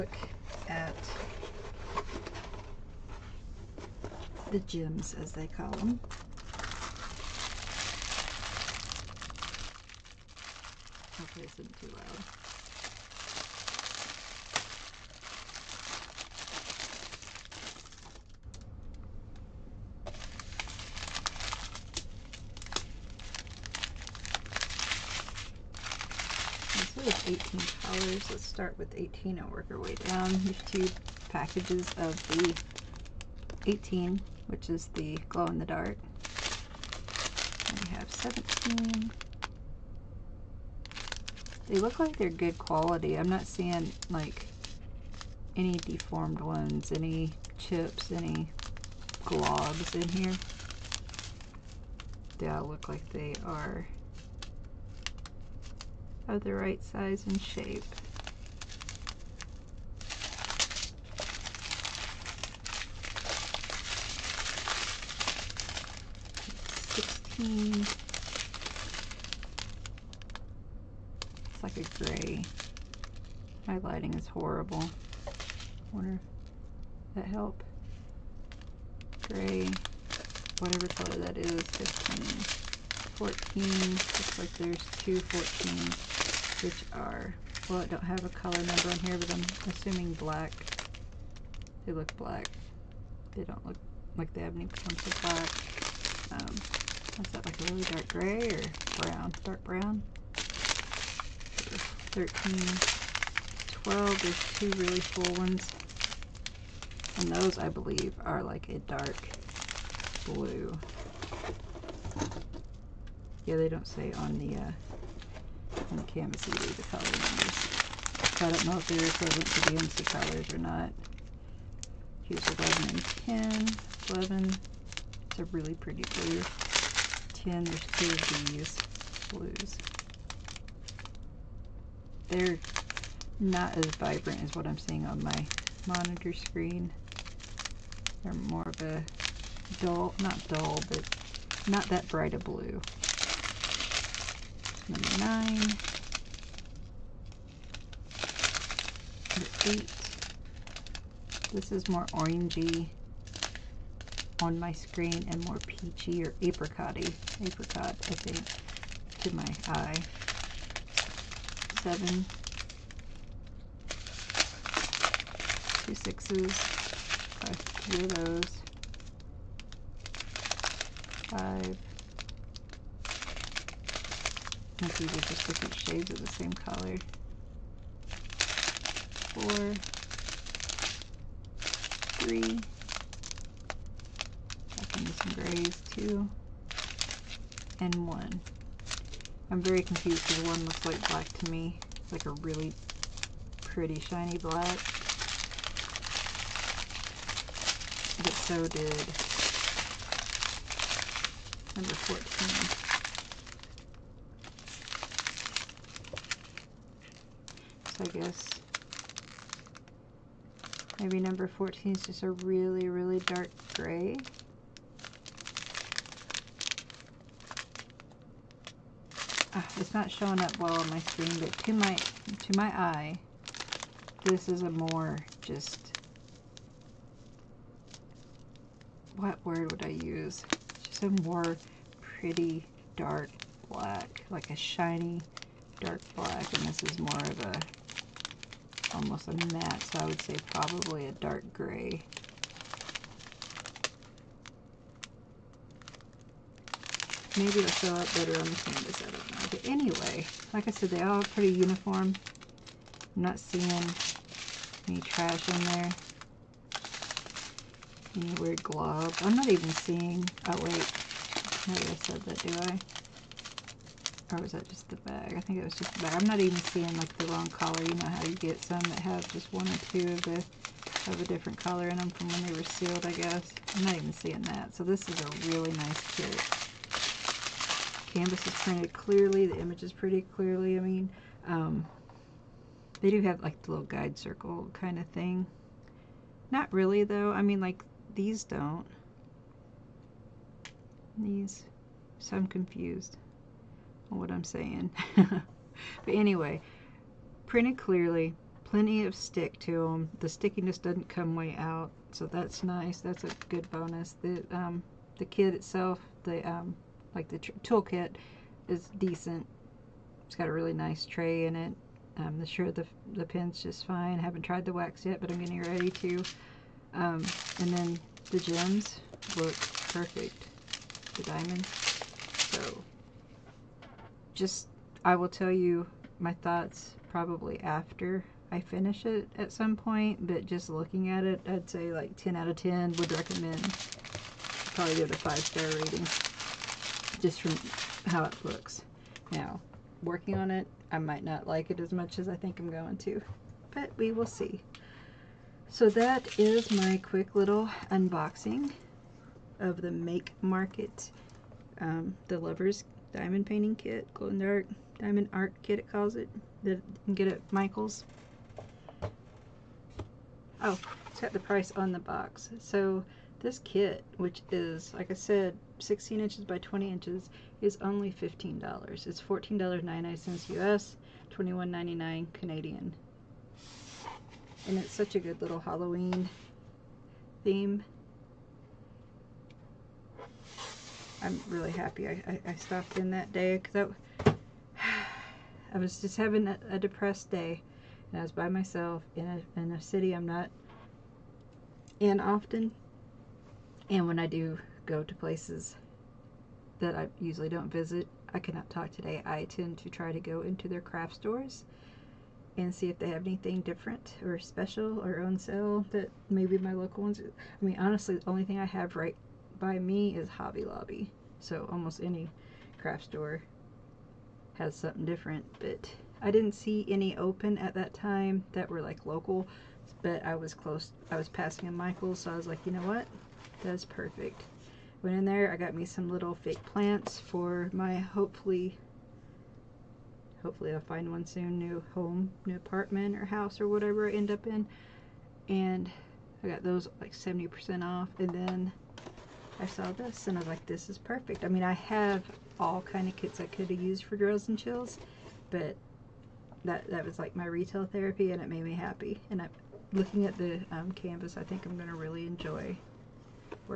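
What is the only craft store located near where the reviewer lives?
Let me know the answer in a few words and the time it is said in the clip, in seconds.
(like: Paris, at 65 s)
Hobby Lobby, at 410 s.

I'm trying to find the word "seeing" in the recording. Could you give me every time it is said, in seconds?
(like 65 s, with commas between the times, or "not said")
43 s, 134 s, 253 s, 259 s, 266 s, 274 s.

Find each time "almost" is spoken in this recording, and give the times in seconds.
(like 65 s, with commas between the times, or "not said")
238 s, 411 s.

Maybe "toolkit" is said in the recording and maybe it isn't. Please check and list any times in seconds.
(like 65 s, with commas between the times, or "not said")
307 s.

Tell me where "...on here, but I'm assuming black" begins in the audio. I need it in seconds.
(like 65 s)
88 s.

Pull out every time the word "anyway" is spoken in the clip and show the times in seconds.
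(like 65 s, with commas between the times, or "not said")
249 s, 296 s.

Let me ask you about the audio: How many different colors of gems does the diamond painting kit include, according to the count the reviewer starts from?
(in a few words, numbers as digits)
18.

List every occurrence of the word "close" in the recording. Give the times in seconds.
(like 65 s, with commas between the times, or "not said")
420 s.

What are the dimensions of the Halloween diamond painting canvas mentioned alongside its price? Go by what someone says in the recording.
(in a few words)
16 by 20 inches.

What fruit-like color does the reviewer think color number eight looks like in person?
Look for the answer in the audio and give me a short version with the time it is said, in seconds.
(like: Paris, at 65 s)
Apricot, at 157 s.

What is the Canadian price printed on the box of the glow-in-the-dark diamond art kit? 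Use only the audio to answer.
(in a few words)
$21.99.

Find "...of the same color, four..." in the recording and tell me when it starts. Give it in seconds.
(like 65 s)
176 s.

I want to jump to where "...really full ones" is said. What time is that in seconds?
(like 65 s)
104 s.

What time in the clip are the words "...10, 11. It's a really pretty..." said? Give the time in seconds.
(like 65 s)
124 s.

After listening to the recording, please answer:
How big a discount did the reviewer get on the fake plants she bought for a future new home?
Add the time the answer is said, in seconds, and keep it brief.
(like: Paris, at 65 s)
70% off, at 437 s.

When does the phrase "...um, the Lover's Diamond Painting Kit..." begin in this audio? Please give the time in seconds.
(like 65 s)
351 s.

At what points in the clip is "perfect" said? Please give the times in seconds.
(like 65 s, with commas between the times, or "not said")
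319 s, 423 s, 440 s.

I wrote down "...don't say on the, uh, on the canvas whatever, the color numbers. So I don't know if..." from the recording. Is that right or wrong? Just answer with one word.
wrong.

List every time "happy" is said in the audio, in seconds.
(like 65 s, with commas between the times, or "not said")
381 s, 448 s.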